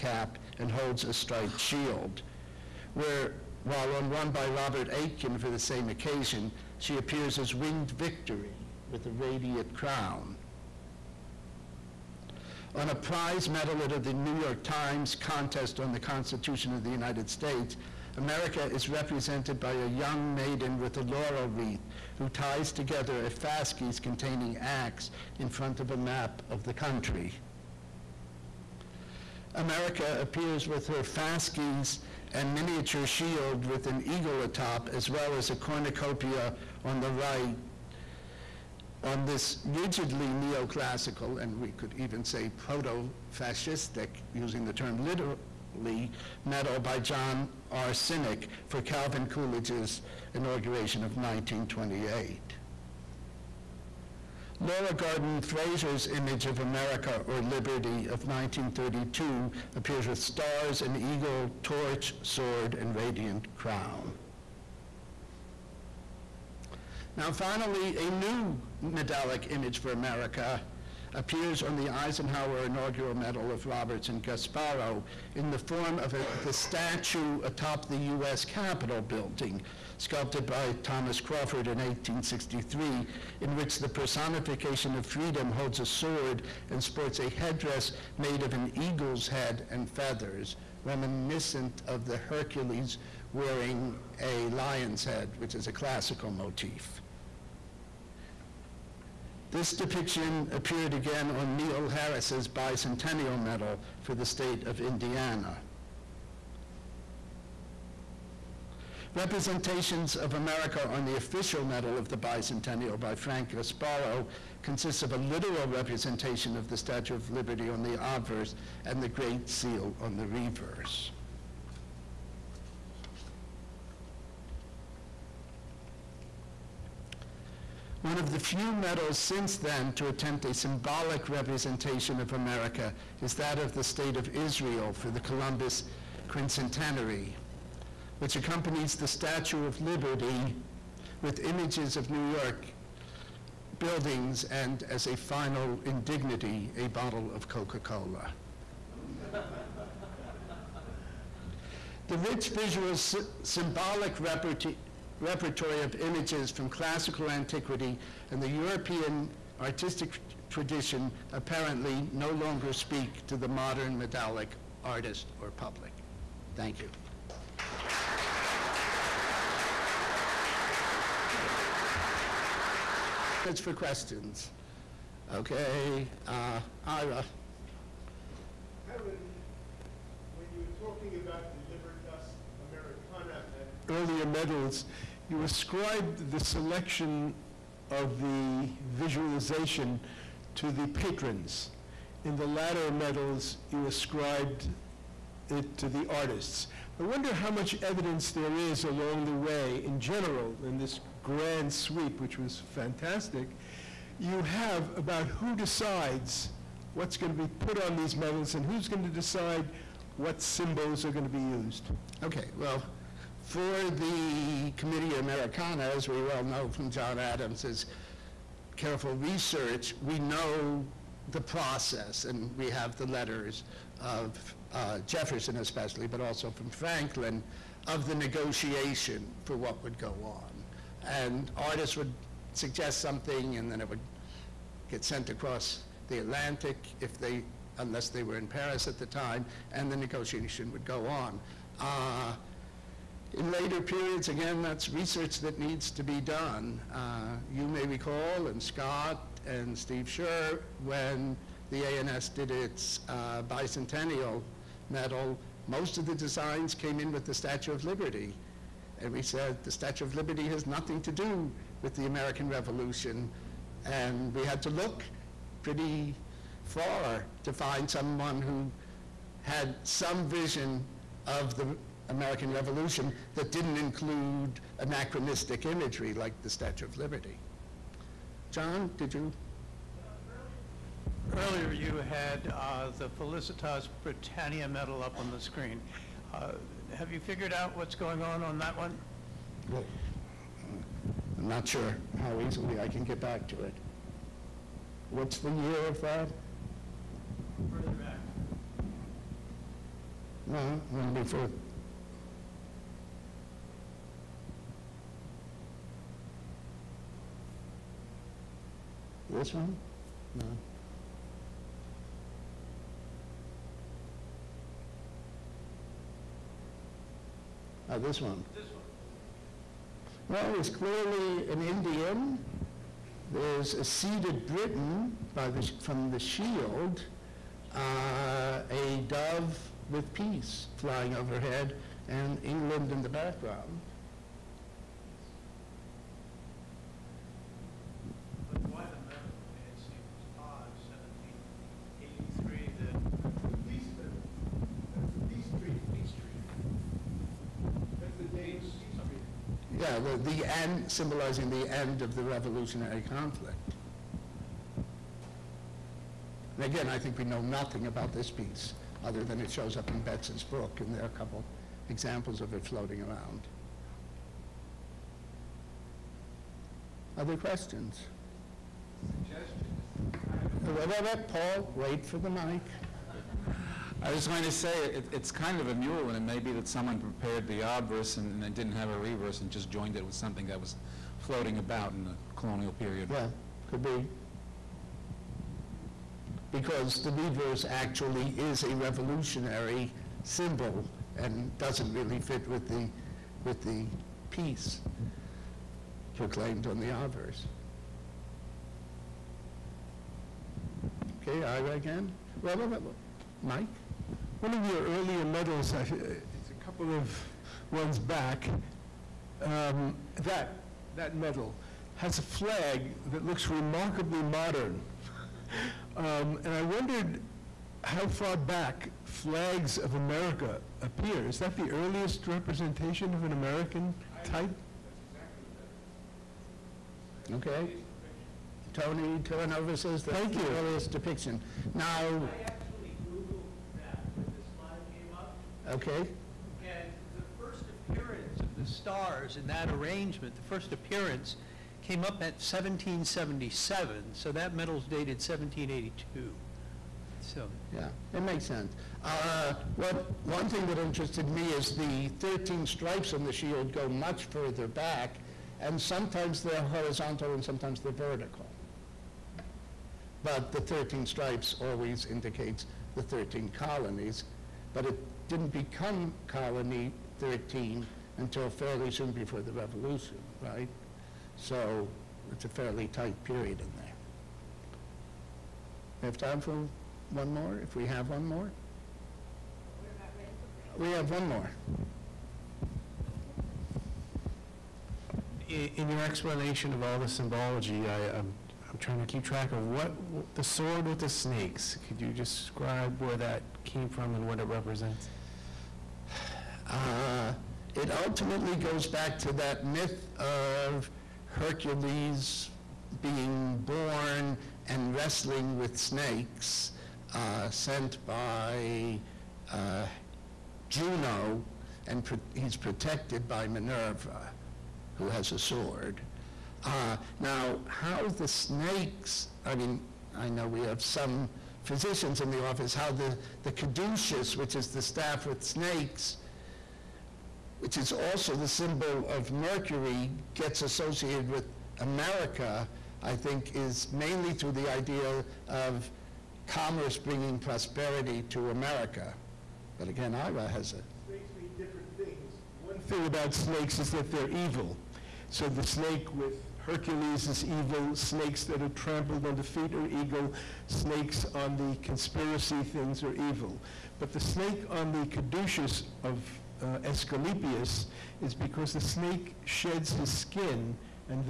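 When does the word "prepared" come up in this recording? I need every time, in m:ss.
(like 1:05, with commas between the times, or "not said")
6:16.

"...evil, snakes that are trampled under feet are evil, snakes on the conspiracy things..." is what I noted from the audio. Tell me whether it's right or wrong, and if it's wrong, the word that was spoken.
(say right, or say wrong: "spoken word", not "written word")
right.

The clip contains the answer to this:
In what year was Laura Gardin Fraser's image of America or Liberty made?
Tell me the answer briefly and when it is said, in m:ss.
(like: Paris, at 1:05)
1932, at 0:58.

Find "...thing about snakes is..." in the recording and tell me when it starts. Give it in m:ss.
9:02.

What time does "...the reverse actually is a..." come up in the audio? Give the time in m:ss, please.
6:27.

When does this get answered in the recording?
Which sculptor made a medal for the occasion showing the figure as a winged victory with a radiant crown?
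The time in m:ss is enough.
0:04.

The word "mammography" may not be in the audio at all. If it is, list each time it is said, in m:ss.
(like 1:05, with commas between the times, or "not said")
not said.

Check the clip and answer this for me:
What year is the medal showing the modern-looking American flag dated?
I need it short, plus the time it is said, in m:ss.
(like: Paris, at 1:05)
1782, at 7:25.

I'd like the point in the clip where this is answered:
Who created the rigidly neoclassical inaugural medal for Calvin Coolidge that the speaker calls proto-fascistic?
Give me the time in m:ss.
0:46.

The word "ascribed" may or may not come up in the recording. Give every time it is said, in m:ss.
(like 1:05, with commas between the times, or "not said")
3:05, 3:13.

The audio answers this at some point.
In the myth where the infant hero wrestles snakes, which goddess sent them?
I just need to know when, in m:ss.
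8:30.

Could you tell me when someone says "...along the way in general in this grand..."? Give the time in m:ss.
3:18.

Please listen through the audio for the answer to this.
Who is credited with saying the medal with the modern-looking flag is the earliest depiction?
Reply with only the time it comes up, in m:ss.
7:08.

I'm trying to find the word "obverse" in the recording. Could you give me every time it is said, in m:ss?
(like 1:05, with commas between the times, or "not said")
1:57, 6:17, 6:36.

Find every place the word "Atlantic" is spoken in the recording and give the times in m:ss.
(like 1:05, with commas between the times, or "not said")
3:56.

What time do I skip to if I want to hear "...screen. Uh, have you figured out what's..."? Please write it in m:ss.
4:45.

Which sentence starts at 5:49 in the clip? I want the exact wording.
yeah, the, the end, symbolizing the end of the revolutionary conflict.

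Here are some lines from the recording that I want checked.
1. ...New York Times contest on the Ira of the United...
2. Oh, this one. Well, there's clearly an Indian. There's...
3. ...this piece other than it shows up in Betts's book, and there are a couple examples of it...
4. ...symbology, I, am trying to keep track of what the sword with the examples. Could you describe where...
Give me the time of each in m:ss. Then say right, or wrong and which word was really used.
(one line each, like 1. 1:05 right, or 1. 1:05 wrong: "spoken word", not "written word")
1. 0:14 wrong: "Constitution", not "Ira"
2. 5:17 right
3. 5:58 right
4. 8:07 wrong: "snakes", not "examples".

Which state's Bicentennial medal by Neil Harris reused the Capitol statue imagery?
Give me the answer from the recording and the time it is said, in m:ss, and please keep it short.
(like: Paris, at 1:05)
Indiana, at 1:44.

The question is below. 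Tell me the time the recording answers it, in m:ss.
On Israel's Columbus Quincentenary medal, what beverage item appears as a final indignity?
2:26.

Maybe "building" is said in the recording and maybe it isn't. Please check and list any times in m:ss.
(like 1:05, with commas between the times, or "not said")
1:19, 2:23.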